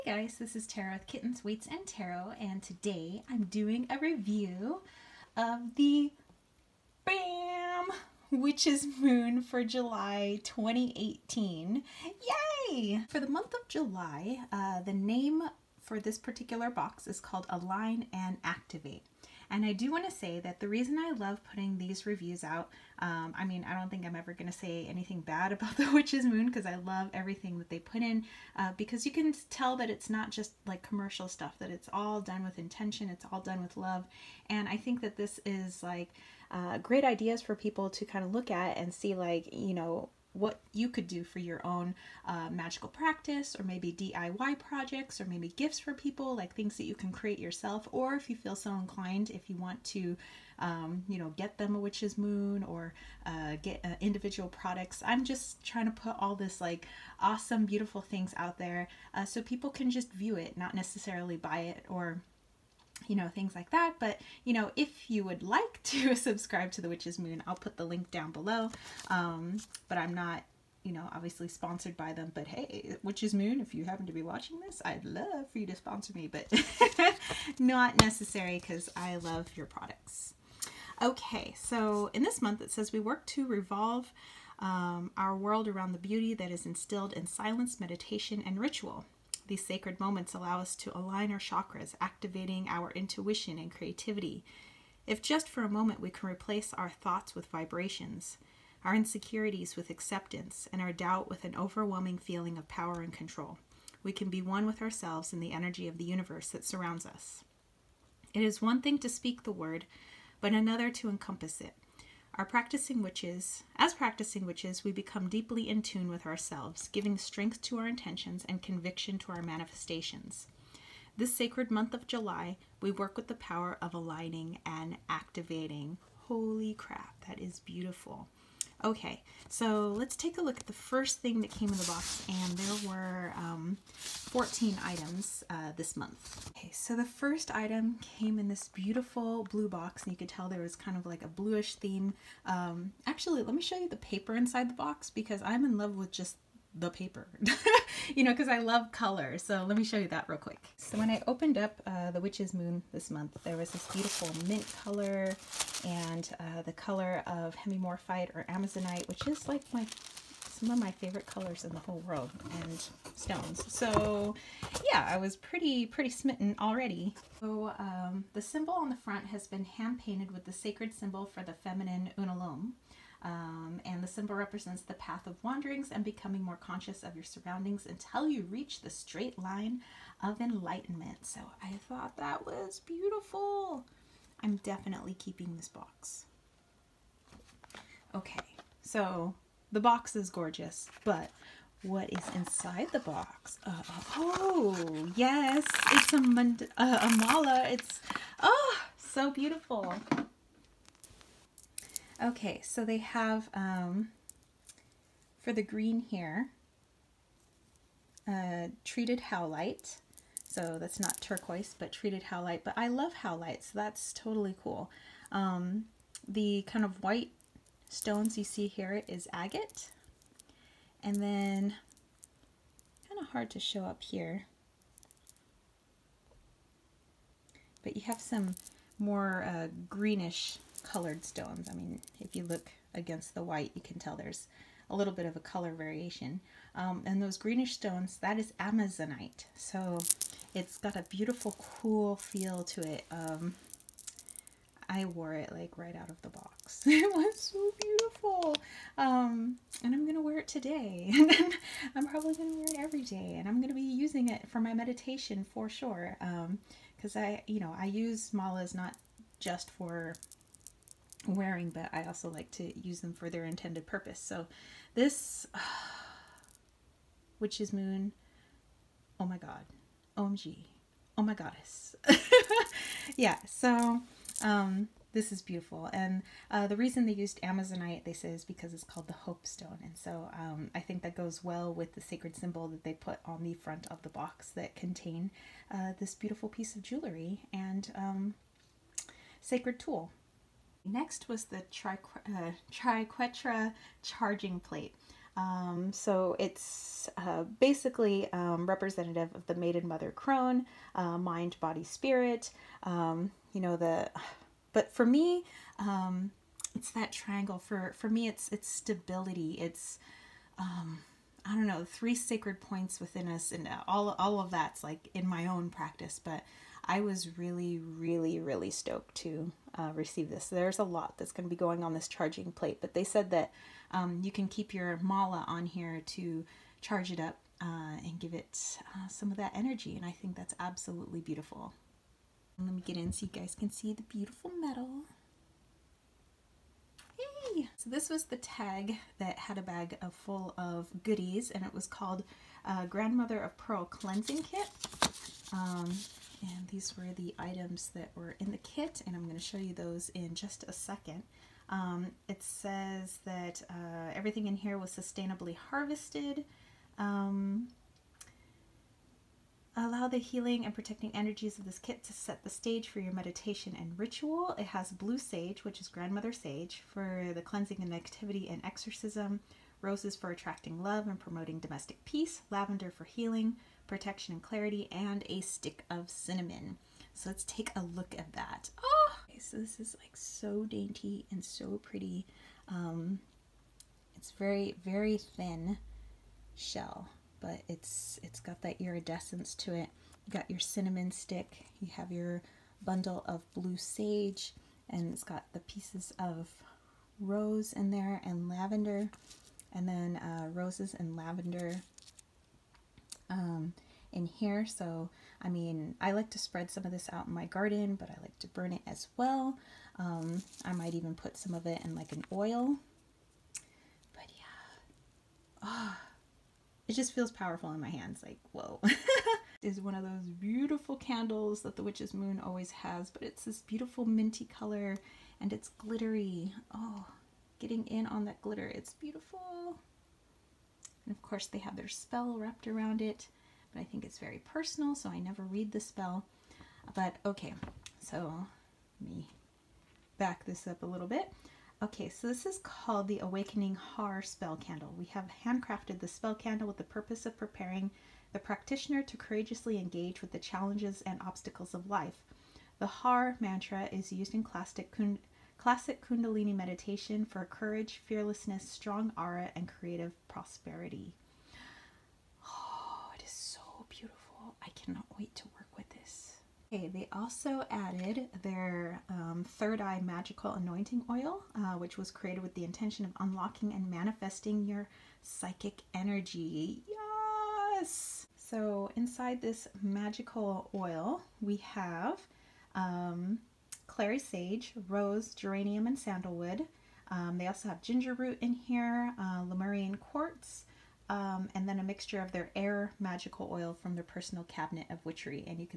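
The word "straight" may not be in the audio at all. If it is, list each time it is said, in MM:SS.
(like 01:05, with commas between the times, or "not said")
02:58.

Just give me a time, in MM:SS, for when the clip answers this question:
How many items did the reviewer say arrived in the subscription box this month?
02:13.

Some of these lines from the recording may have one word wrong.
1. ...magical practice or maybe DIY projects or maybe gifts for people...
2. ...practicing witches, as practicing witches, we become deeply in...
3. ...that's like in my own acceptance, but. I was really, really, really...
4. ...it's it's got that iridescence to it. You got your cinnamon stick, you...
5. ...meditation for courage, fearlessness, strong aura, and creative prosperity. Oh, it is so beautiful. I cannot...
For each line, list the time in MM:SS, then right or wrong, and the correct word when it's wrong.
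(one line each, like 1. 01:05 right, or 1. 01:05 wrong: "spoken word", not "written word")
1. 00:42 right
2. 01:52 right
3. 05:14 wrong: "practice", not "acceptance"
4. 06:27 right
5. 07:36 right.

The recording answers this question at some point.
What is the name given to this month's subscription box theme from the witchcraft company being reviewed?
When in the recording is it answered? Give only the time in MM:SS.
00:17.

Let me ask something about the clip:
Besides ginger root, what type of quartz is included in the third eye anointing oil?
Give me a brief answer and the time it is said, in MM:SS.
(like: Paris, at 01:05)
Lemurian quartz, at 08:09.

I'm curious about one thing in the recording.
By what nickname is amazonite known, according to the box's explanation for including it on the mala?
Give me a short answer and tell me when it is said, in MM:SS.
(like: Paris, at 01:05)
the Hope Stone, at 04:39.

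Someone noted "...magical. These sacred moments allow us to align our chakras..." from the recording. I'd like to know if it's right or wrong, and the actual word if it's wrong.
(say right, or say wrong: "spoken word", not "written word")
wrong: "ritual", not "magical".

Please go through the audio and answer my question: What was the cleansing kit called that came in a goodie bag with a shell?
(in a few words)
Grandmother of Pearl.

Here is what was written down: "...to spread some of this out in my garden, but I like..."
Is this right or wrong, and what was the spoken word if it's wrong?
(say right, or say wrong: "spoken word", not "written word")
right.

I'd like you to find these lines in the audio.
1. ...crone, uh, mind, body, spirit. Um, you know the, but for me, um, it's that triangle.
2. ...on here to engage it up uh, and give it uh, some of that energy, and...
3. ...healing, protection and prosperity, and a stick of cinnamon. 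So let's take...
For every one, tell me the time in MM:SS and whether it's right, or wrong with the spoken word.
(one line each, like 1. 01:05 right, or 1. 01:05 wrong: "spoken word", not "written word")
1. 05:00 right
2. 05:25 wrong: "charge", not "engage"
3. 06:13 wrong: "clarity", not "prosperity".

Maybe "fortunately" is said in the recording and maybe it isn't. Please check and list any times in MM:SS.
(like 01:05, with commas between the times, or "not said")
not said.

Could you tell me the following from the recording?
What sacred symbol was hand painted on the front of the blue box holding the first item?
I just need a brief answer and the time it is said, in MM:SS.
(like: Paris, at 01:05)
feminine unalome, at 02:51.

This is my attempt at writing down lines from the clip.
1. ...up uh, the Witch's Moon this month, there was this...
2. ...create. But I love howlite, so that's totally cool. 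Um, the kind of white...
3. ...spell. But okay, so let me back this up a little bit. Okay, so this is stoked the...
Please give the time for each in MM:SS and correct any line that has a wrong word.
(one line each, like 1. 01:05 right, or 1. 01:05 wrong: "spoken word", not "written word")
1. 02:31 right
2. 03:32 wrong: "howlite", not "create"
3. 07:15 wrong: "called", not "stoked".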